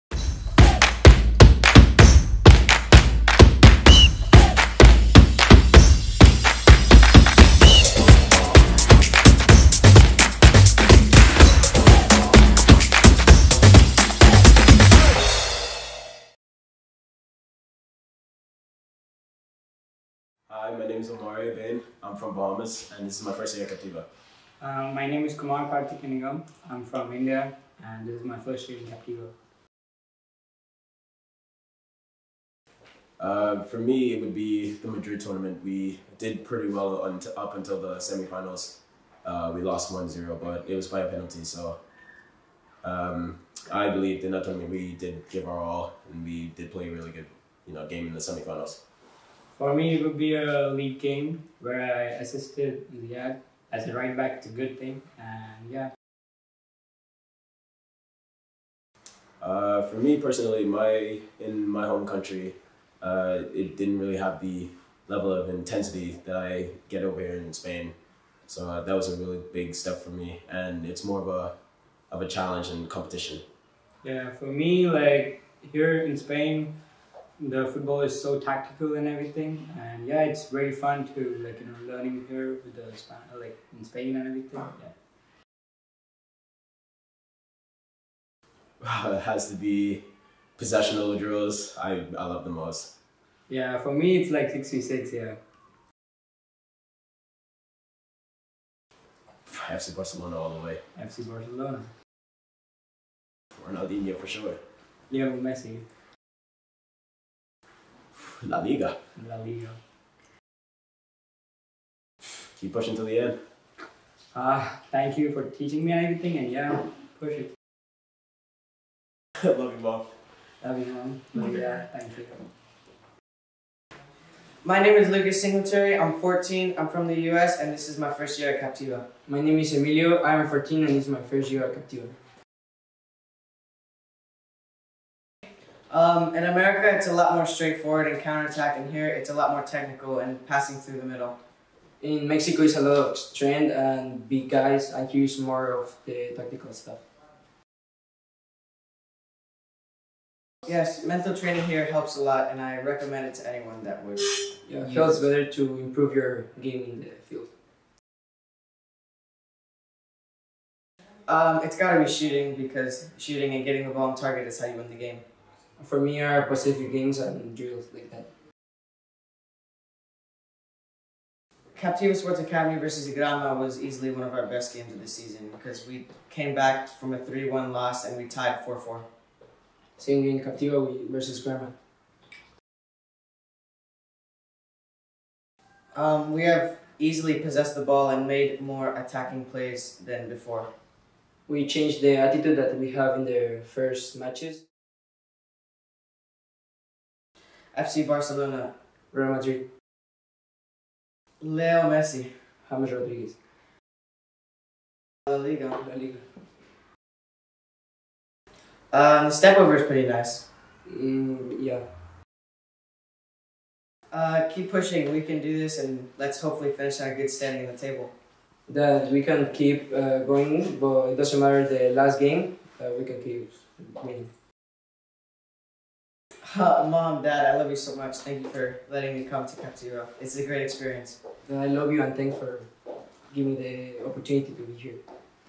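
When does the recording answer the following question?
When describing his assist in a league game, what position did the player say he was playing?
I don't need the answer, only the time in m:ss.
0:53.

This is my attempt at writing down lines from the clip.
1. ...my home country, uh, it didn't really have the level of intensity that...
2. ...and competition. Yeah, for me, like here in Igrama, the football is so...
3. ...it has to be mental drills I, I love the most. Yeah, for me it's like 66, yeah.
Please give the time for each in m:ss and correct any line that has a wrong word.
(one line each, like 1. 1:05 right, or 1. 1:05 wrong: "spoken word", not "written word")
1. 1:01 right
2. 1:12 wrong: "Spain", not "Igrama"
3. 1:29 wrong: "possessional", not "mental".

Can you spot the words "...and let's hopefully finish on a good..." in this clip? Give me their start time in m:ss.
3:35.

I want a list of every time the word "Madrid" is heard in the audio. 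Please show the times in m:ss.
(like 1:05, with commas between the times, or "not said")
0:34, 3:19.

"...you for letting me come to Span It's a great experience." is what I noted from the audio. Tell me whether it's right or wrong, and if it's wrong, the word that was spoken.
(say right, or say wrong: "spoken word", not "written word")
wrong: "Camp", not "Span".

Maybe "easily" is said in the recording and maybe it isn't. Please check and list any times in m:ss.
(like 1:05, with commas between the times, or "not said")
2:53, 3:06.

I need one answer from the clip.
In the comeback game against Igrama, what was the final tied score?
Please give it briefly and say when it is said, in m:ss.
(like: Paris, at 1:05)
4-4, at 2:58.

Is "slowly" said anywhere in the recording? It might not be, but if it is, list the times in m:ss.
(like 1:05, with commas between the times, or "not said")
not said.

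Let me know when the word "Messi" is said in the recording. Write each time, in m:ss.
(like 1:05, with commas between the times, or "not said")
1:45, 3:21.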